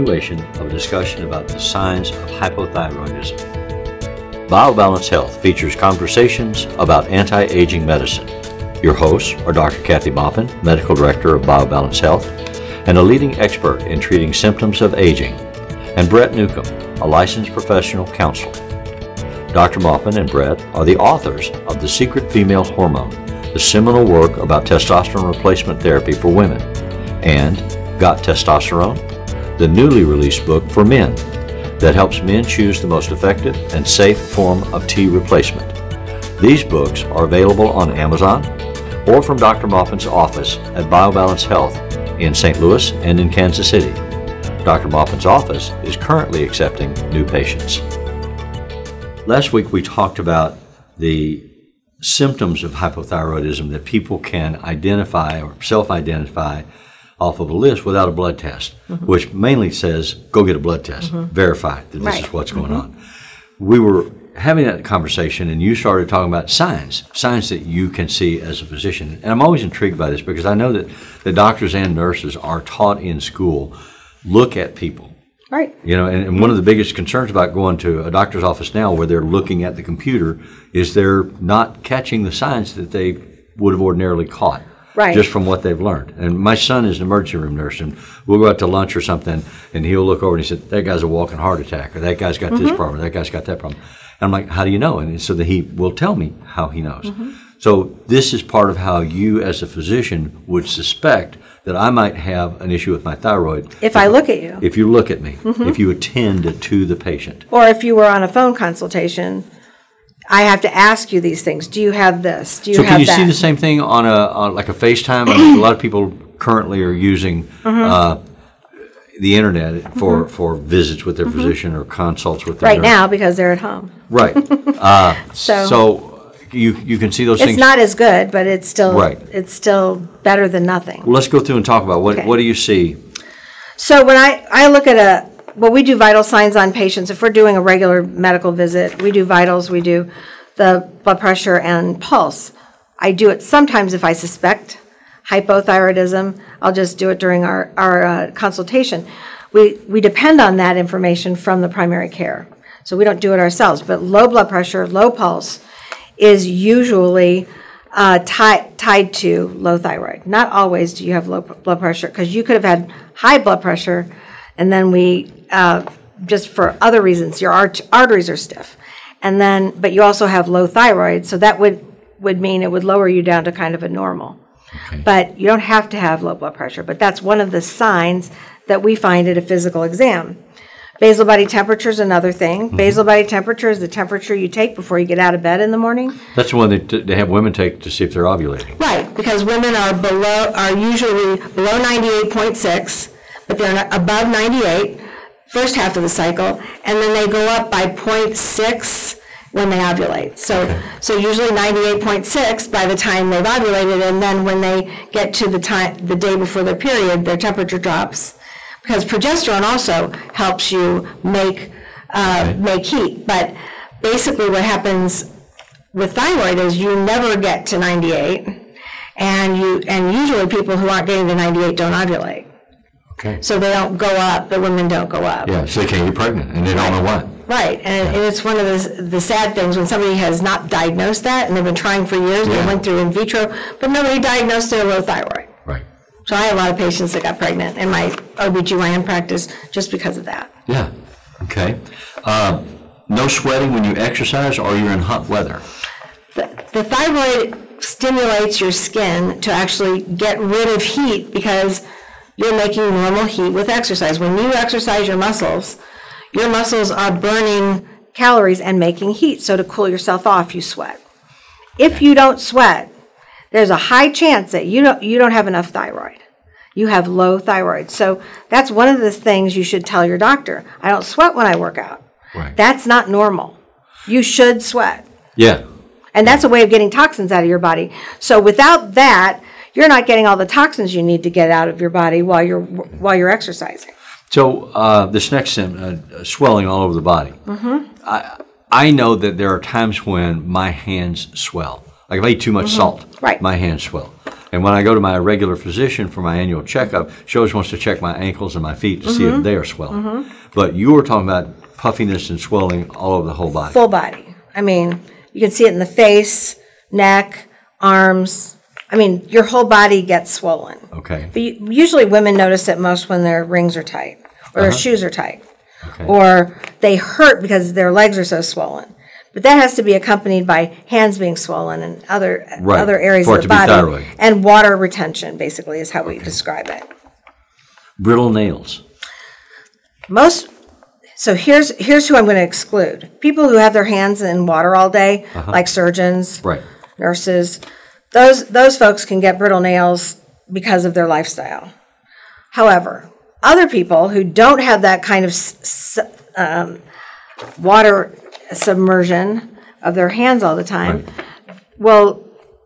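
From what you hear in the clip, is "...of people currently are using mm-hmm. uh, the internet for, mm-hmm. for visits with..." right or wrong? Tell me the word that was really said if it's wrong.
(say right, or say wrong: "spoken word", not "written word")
right.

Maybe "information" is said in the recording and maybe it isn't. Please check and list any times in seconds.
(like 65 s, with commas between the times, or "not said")
150 s.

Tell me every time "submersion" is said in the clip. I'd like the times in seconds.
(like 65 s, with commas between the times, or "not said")
348 s.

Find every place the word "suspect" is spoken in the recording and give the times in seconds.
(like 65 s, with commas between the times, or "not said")
100 s, 144 s.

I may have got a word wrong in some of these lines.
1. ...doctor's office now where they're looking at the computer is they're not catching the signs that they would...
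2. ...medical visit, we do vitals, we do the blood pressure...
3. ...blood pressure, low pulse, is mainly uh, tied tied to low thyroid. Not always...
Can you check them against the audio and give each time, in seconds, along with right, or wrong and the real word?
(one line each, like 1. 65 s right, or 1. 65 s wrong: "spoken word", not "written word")
1. 78 s right
2. 138 s right
3. 154 s wrong: "usually", not "mainly".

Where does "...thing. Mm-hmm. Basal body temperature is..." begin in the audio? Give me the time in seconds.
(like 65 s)
182 s.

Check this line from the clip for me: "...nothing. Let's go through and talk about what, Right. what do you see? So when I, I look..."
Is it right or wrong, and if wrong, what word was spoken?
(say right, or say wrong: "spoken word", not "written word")
wrong: "Okay", not "Right".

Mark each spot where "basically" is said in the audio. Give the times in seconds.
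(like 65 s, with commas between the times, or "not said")
214 s, 325 s.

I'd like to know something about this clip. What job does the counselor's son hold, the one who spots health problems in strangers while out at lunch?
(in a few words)
Emergency room nurse.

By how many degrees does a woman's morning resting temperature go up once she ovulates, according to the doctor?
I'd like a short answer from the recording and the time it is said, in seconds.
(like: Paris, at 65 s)
0.6, at 197 s.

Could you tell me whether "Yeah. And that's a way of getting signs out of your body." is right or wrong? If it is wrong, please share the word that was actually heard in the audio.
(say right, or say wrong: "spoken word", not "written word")
wrong: "toxins", not "signs".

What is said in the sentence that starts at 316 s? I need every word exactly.
or they hurt because their legs are so swollen.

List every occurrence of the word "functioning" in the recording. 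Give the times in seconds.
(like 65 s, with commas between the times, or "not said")
not said.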